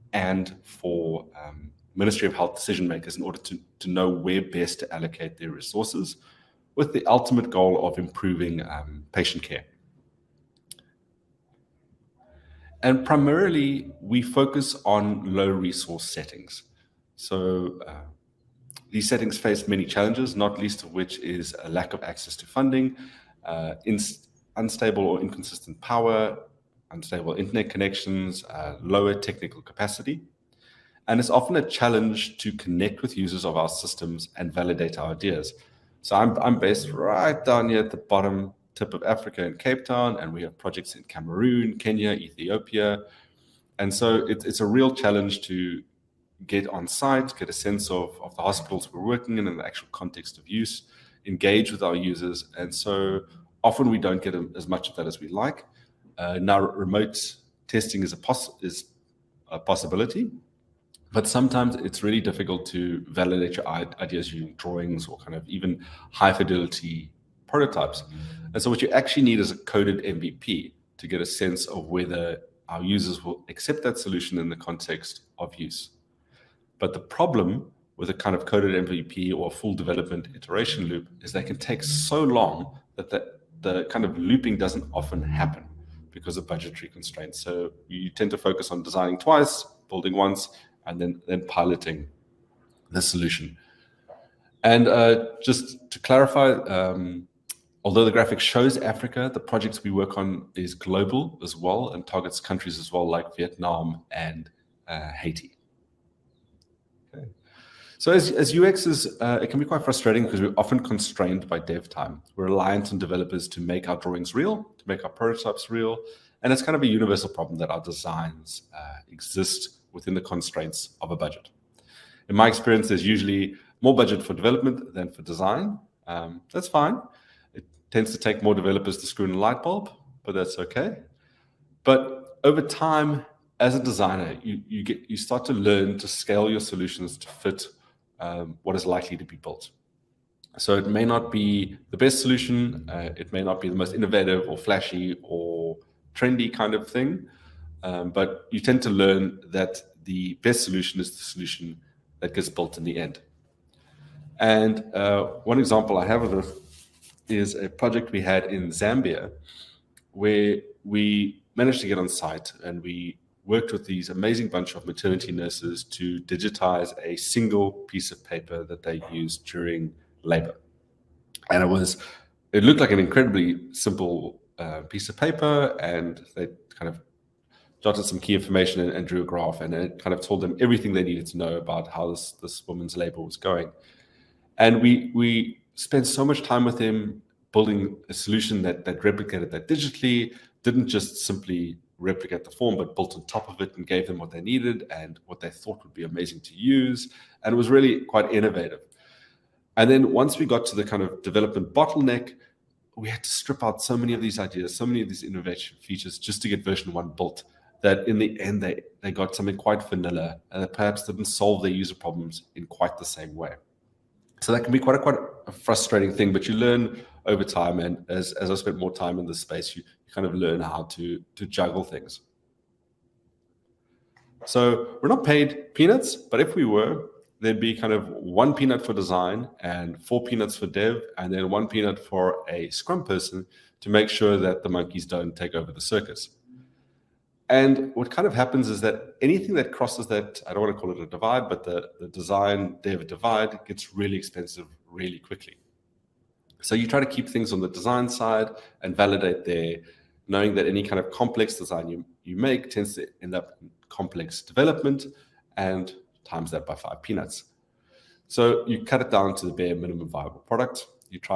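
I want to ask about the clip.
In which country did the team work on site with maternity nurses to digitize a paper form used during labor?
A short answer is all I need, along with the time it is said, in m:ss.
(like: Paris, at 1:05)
Zambia, at 2:38.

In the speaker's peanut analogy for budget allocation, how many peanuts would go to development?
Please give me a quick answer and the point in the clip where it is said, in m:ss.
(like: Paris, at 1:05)
4, at 3:50.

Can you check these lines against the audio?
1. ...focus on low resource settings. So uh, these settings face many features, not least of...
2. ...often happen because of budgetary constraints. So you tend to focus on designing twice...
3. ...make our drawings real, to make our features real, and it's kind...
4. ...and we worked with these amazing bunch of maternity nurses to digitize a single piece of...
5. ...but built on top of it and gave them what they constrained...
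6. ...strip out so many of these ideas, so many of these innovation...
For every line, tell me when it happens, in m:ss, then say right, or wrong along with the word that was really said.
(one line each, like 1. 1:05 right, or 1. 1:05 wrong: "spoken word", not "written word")
1. 0:14 wrong: "challenges", not "features"
2. 1:24 right
3. 1:53 wrong: "prototypes", not "features"
4. 2:42 right
5. 3:12 wrong: "needed", not "constrained"
6. 3:23 right.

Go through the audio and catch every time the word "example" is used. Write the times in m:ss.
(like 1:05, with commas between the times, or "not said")
2:35.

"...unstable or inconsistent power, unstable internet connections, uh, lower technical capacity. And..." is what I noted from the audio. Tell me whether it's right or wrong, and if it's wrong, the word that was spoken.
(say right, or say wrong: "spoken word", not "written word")
right.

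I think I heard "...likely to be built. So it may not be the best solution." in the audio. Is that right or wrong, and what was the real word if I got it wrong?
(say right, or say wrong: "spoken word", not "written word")
right.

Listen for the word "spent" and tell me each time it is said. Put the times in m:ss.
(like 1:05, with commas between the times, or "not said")
3:05, 3:38.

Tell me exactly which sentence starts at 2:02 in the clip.
In my experience, there's usually more budget for development than for design.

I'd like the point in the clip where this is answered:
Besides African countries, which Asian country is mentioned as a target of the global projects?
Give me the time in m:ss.
1:43.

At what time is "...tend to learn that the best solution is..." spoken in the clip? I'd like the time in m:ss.
2:28.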